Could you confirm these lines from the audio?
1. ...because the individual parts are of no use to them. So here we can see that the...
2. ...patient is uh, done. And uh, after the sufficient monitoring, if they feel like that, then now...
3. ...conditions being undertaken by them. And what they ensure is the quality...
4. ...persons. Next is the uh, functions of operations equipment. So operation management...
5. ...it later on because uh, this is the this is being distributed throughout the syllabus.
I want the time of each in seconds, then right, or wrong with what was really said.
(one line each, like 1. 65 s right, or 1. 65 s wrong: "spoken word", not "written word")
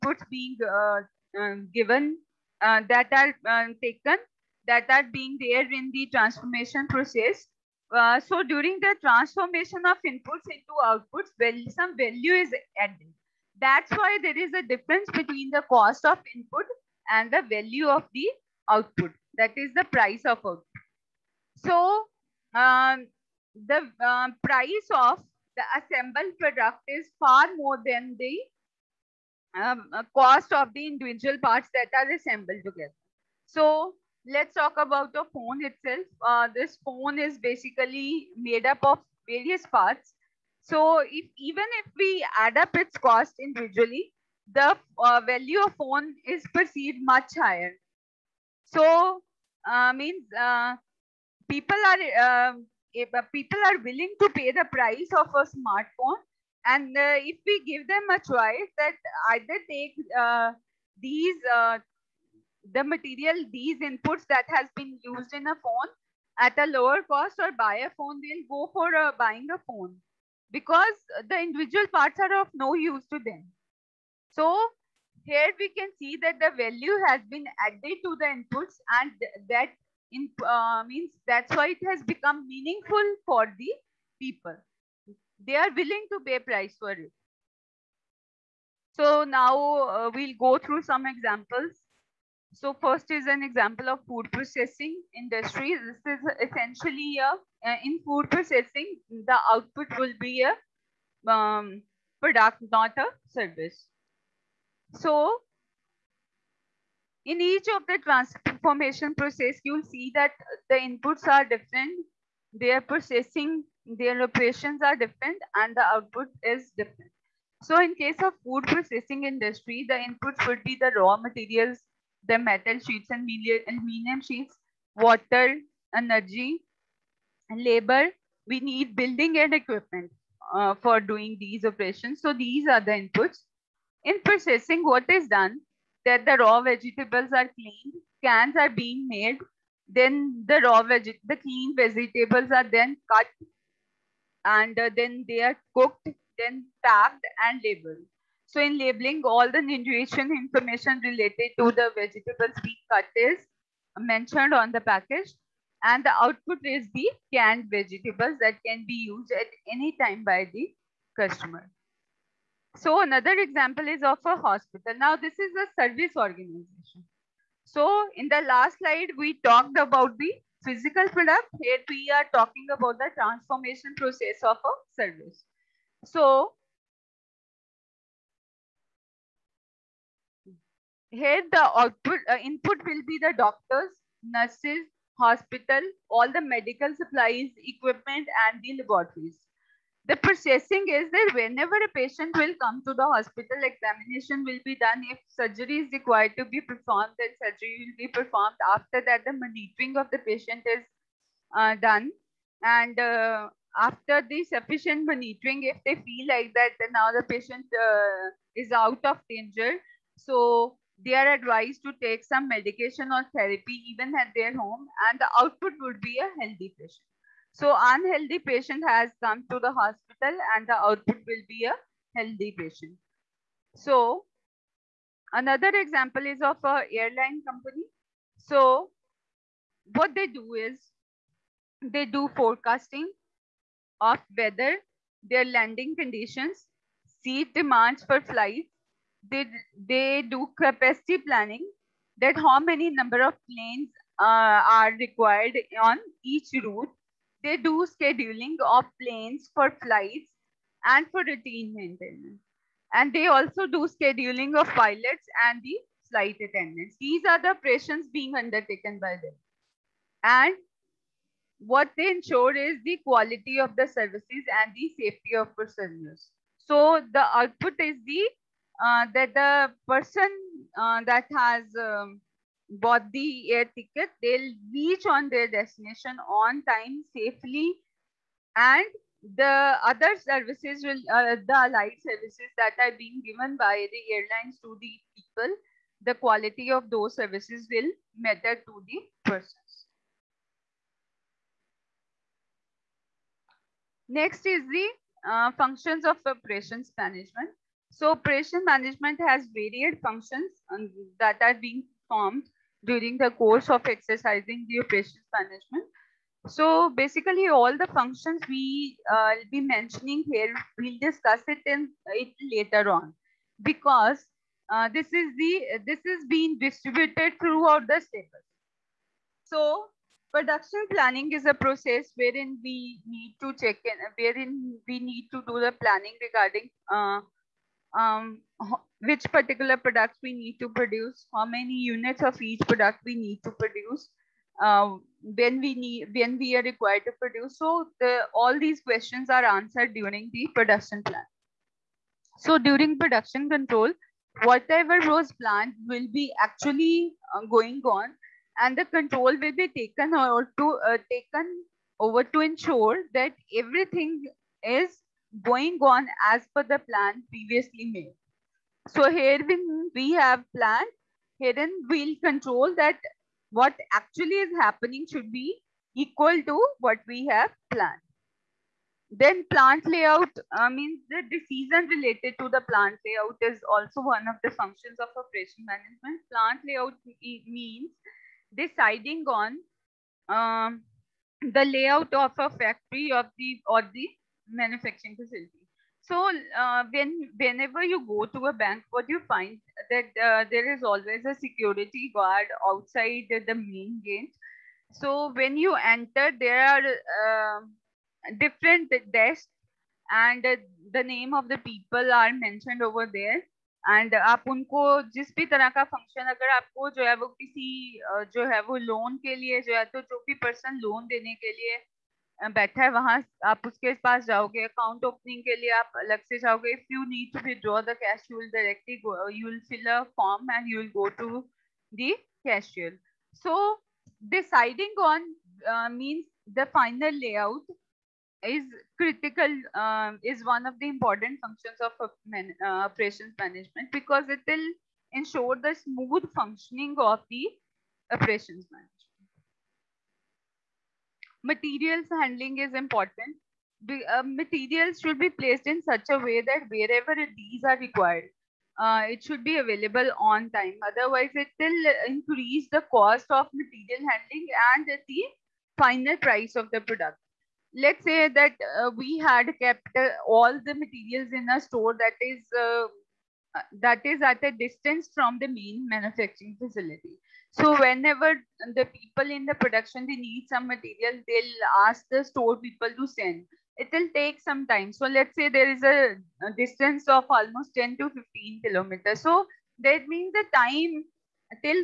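1. 70 s right
2. 200 s right
3. 257 s wrong: "operations", not "conditions"
4. 289 s wrong: "management", not "equipment"
5. 312 s right.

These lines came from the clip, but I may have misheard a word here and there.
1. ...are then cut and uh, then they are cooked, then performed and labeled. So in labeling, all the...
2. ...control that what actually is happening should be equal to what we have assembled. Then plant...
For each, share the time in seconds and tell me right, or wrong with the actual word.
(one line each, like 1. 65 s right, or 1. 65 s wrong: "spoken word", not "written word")
1. 142 s wrong: "packed", not "performed"
2. 362 s wrong: "planned", not "assembled".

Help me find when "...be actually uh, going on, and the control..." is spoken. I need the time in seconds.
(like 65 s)
346 s.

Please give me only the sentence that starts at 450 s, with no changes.
Otherwise, it will increase the cost of material handling and the final price of the product.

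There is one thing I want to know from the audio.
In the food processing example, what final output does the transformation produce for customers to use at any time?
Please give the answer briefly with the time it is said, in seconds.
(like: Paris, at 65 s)
Canned vegetables, at 157 s.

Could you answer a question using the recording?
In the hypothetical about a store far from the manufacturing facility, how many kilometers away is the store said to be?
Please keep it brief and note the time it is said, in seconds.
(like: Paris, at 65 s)
10 to 15, at 477 s.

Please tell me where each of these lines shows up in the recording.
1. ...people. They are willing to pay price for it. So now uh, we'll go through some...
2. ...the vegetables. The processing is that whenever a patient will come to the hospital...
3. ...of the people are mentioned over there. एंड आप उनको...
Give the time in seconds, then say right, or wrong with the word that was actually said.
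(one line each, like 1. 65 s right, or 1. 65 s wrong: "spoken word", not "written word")
1. 84 s right
2. 188 s wrong: "laboratories", not "vegetables"
3. 401 s right.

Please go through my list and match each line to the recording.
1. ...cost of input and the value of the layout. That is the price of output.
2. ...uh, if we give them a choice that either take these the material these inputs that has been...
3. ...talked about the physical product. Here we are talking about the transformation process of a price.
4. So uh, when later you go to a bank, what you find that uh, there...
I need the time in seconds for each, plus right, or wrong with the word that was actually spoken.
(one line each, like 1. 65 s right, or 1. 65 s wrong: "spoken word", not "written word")
1. 15 s wrong: "output", not "layout"
2. 56 s right
3. 169 s wrong: "service", not "price"
4. 386 s wrong: "whenever", not "later".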